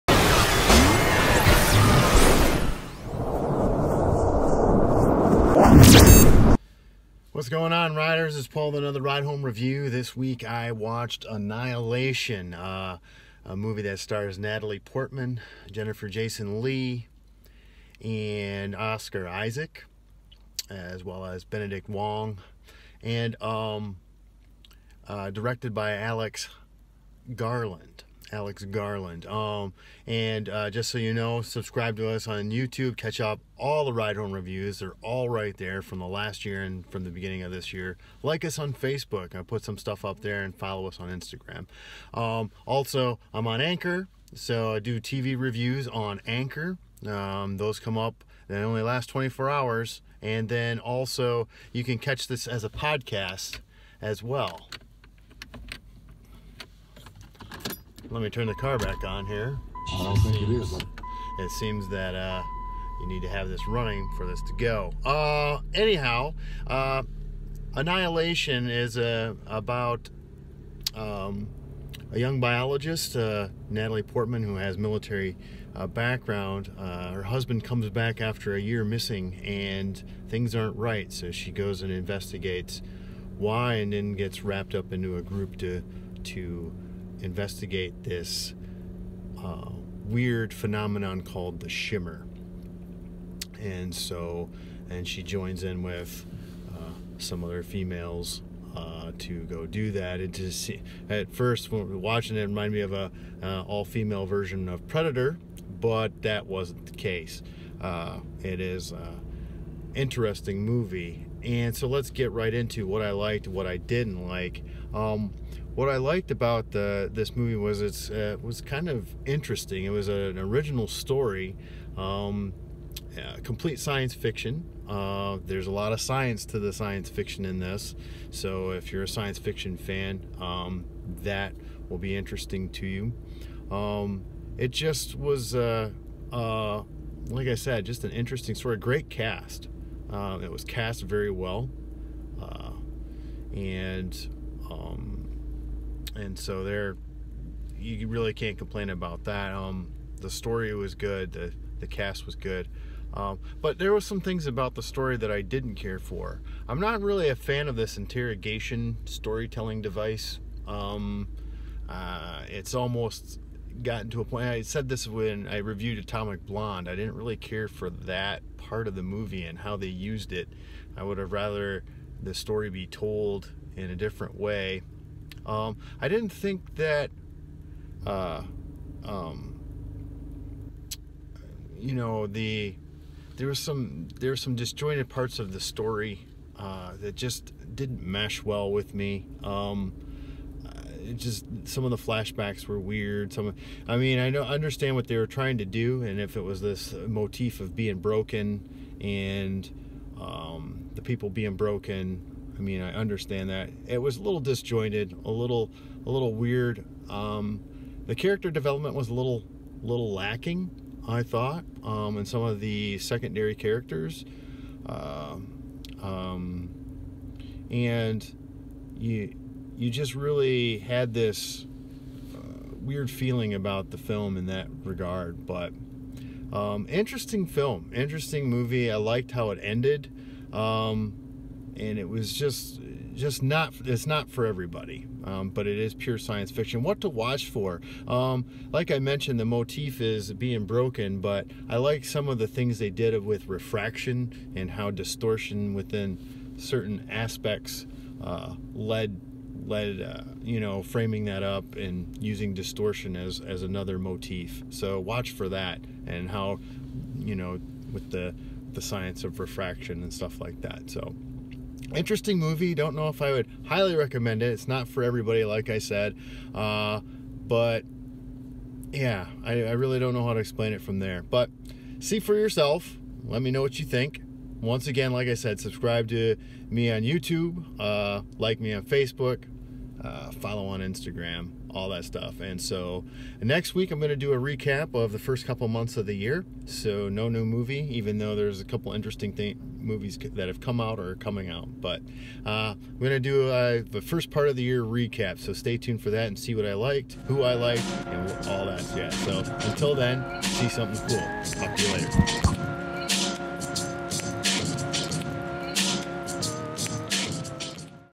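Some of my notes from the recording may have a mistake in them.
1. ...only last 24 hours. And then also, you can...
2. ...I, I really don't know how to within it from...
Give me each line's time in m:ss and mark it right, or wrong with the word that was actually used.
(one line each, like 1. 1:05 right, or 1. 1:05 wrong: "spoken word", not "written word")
1. 0:48 right
2. 4:29 wrong: "explain", not "within".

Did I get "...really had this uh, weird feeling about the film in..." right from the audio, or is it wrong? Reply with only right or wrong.
right.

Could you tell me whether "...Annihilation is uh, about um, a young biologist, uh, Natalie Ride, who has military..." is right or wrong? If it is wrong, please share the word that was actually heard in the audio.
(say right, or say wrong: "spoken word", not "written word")
wrong: "Portman", not "Ride".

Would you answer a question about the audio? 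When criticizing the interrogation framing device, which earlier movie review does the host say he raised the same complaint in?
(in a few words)
Atomic Blonde.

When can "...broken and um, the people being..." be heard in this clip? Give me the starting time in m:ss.
3:17.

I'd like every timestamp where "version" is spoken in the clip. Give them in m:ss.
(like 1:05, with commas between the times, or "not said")
1:44.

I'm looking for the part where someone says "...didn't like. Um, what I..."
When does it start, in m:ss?
1:53.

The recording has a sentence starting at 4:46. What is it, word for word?
So no new movie, even though there's a couple interesting thing, movies that have come out or are coming out.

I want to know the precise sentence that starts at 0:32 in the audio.
Catch up all the ride home reviews.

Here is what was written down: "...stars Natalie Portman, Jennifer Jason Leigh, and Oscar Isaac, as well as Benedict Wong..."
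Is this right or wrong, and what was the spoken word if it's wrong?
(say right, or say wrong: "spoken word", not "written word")
right.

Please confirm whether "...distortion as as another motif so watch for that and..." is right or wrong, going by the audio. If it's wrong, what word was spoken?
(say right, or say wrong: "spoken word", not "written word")
right.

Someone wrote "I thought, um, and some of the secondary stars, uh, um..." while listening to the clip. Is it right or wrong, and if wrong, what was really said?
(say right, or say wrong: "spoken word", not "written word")
wrong: "characters", not "stars".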